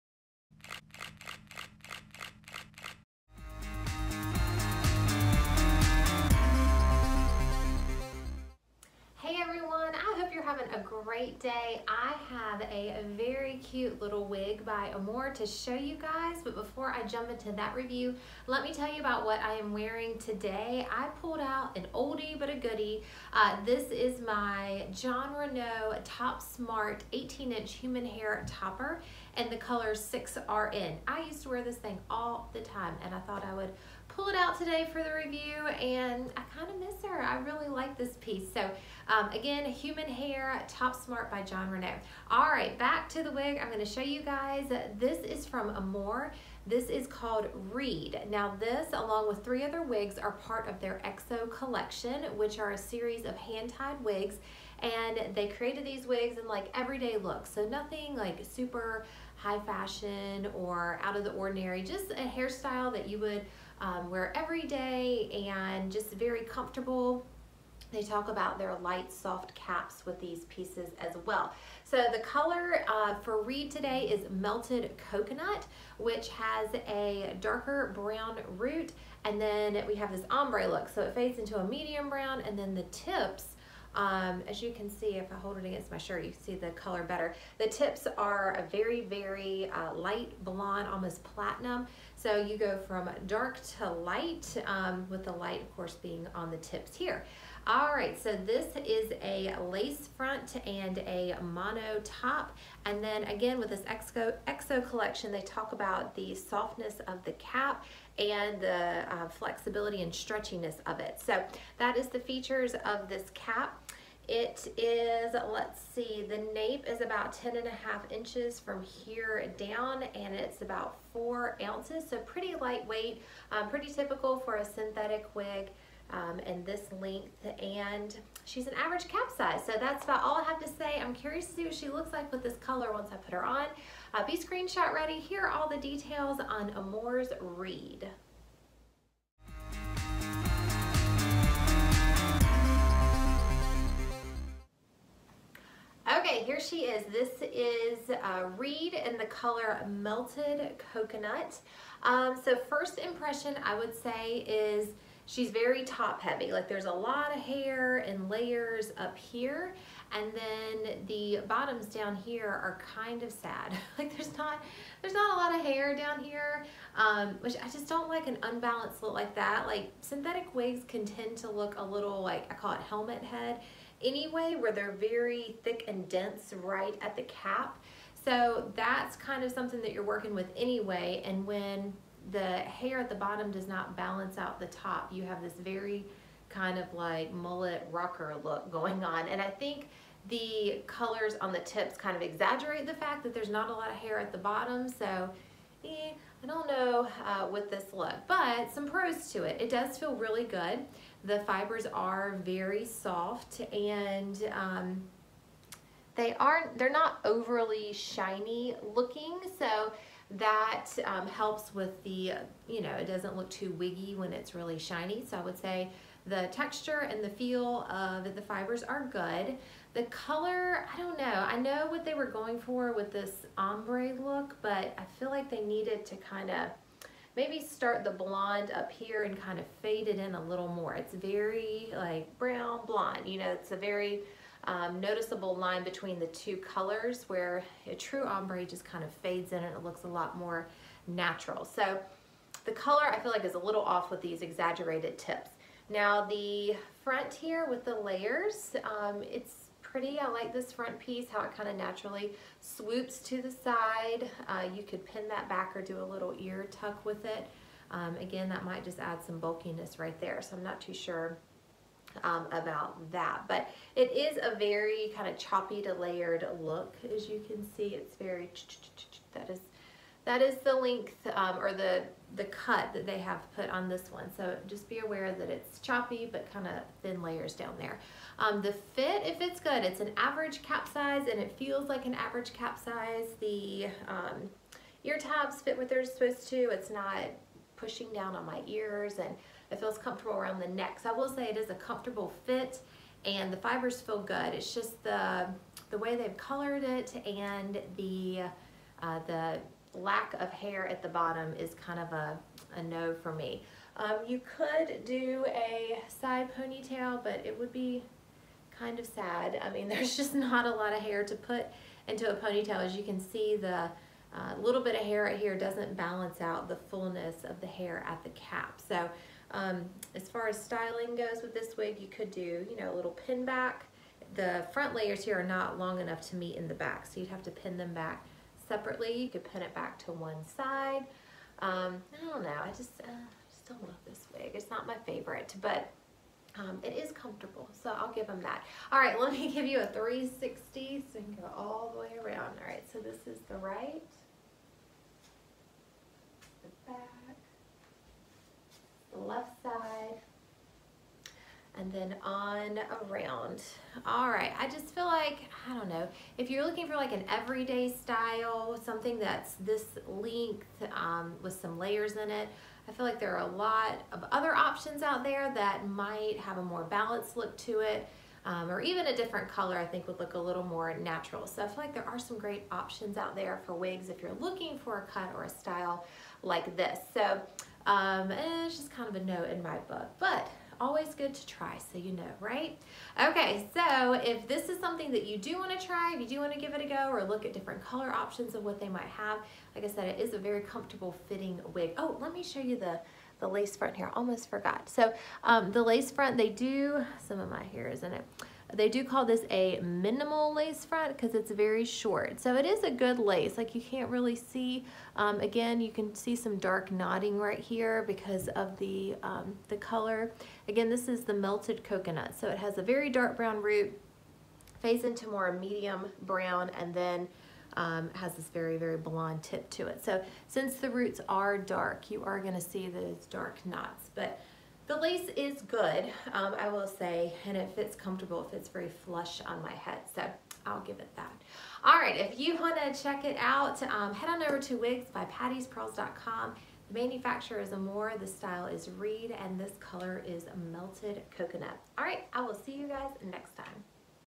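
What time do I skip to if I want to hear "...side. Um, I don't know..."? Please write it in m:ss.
5:30.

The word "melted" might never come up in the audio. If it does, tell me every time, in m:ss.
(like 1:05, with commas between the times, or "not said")
1:14, 2:29, 6:51, 7:20.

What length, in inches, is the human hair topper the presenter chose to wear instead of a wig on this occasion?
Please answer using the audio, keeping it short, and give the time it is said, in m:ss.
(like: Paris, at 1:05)
18-inch, at 0:27.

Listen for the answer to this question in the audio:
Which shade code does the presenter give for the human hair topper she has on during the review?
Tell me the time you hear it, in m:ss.
0:29.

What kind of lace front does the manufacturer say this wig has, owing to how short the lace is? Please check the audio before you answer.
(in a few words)
minimal lace front.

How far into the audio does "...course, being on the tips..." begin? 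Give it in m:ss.
1:35.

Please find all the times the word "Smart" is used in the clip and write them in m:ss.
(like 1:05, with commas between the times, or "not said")
0:26, 0:40.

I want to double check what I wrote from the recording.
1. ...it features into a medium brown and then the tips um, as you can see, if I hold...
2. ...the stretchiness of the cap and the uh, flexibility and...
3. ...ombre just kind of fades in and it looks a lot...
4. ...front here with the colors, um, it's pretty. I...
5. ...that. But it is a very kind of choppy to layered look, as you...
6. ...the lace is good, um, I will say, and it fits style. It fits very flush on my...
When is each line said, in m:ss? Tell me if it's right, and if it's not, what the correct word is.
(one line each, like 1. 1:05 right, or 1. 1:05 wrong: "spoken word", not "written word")
1. 1:21 wrong: "fades", not "features"
2. 1:46 wrong: "softness", not "stretchiness"
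3. 3:58 right
4. 4:07 wrong: "layers", not "colors"
5. 4:23 right
6. 7:04 wrong: "comfortable", not "style".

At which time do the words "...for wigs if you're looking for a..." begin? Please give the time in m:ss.
6:13.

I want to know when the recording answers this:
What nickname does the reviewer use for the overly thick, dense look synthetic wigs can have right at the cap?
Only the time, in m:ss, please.
2:52.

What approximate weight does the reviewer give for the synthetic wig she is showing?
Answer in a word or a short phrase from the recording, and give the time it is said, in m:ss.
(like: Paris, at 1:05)
four ounces, at 2:01.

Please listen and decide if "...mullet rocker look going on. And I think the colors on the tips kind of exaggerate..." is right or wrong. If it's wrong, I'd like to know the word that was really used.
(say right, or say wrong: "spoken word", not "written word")
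right.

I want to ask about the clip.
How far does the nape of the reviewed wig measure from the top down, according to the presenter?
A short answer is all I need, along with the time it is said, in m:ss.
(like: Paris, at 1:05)
10 and a half inches, at 1:57.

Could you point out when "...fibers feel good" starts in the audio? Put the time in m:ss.
4:53.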